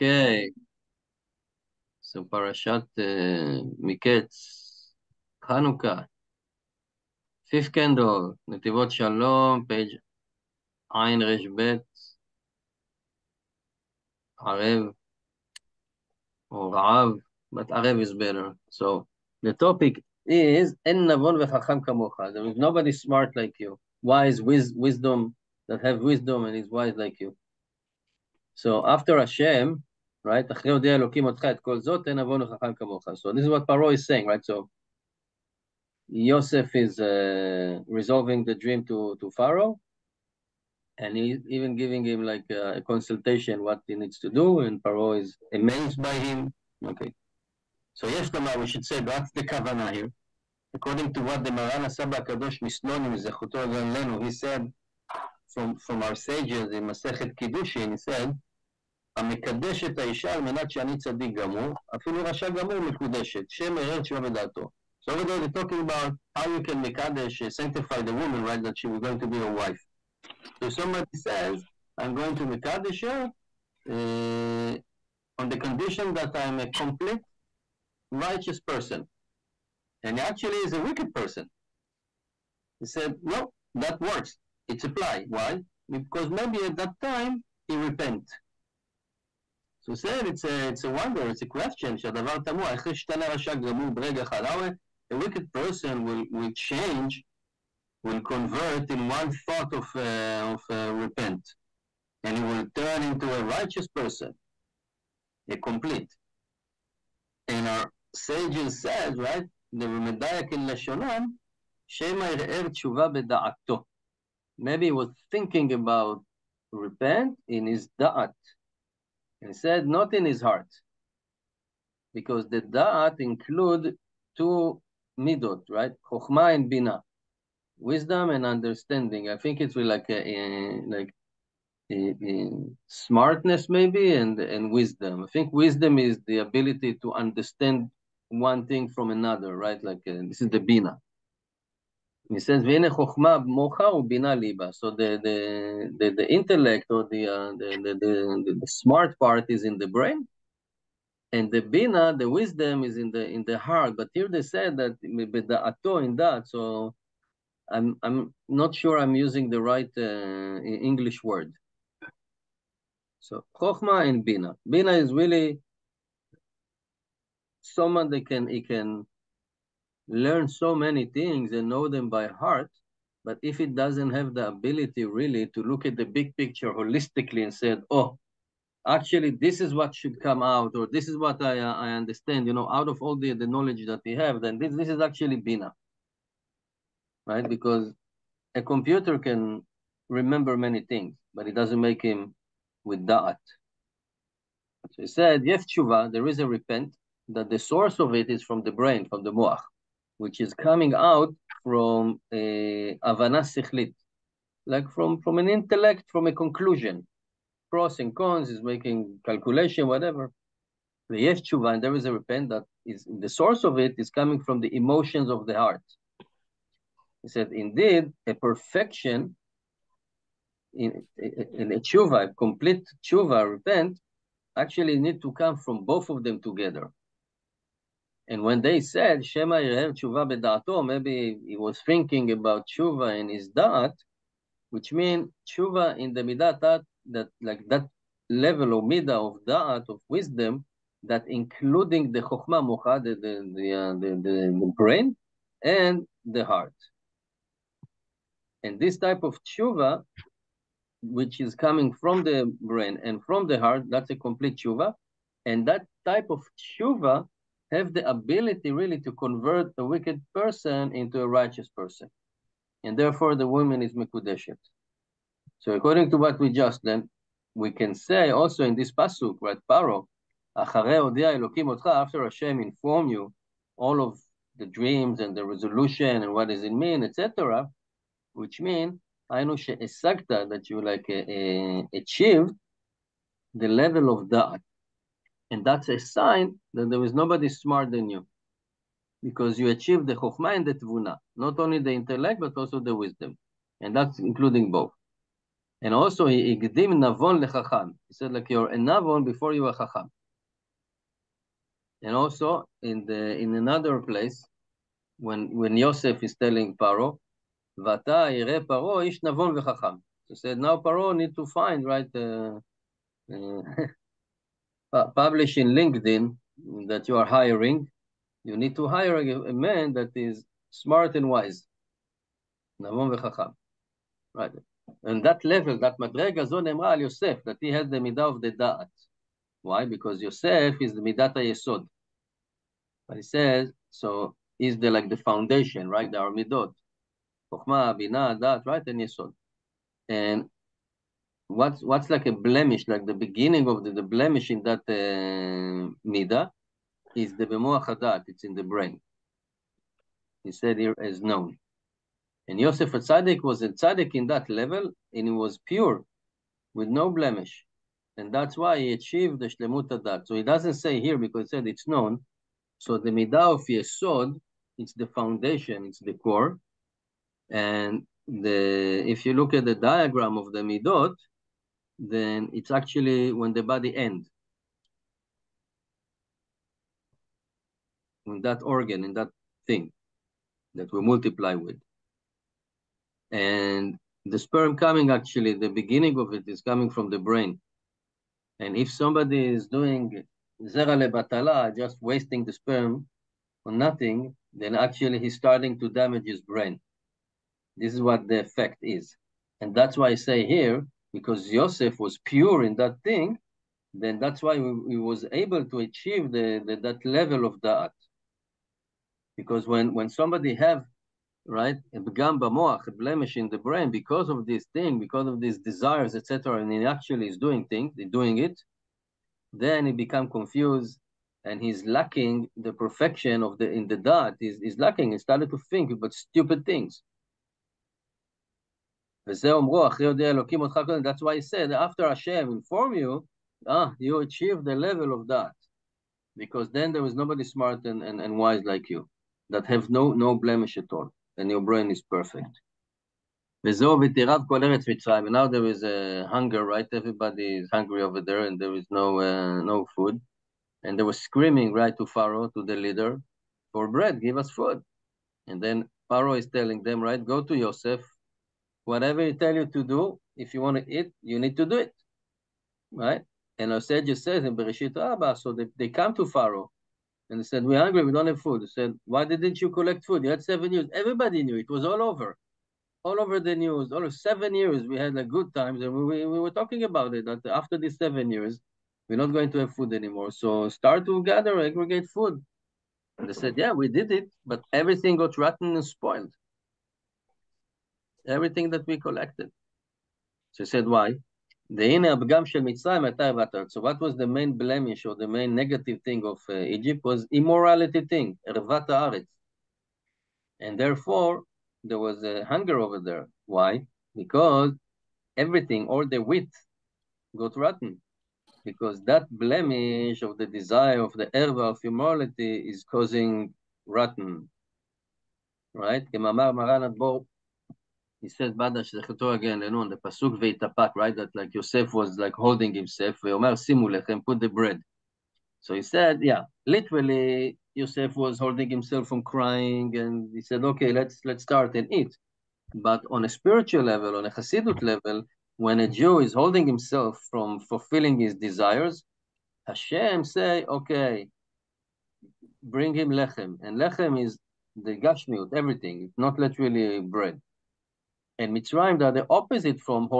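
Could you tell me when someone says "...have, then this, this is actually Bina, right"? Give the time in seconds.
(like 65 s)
184 s.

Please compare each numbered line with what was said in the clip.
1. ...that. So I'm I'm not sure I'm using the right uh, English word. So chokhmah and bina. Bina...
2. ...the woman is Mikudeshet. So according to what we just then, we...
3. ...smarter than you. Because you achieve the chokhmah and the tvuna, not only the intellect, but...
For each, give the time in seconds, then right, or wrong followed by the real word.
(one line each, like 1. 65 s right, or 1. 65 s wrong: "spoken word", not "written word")
1. 156 s right
2. 263 s right
3. 287 s right.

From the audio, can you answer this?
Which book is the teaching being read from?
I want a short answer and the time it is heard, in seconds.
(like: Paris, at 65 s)
Netivot Shalom, at 8 s.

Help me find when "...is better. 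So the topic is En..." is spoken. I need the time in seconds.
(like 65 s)
18 s.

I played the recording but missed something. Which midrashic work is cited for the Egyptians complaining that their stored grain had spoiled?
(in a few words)
Bereshit Rabba.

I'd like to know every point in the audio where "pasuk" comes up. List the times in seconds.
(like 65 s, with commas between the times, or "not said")
268 s, 520 s.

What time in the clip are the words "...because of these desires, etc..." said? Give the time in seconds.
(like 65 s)
414 s.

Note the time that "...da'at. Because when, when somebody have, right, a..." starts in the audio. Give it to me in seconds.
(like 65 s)
407 s.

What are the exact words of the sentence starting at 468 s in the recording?
They said, Why didn't you collect food?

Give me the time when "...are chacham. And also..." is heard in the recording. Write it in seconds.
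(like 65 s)
299 s.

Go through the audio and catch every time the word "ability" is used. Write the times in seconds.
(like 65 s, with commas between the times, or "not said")
136 s, 174 s, 258 s.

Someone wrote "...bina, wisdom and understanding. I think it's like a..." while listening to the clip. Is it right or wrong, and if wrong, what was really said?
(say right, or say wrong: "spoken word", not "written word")
right.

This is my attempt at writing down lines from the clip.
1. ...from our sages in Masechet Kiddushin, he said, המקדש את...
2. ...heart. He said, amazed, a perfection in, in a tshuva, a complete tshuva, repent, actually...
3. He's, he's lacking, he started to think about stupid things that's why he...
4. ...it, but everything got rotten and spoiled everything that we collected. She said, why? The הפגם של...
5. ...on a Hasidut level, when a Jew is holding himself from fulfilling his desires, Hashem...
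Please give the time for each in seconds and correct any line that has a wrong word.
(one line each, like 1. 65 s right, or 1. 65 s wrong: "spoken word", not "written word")
1. 55 s right
2. 215 s wrong: "indeed", not "amazed"
3. 424 s right
4. 484 s right
5. 534 s right.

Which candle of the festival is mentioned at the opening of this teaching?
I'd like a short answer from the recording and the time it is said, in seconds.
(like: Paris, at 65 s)
Fifth, at 7 s.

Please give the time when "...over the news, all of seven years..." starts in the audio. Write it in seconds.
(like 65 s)
473 s.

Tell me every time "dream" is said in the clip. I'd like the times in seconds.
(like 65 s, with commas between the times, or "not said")
38 s, 274 s.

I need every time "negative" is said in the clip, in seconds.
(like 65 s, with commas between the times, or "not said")
495 s.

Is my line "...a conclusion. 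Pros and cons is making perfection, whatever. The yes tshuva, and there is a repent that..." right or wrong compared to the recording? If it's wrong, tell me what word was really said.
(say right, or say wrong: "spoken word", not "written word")
wrong: "calculation", not "perfection".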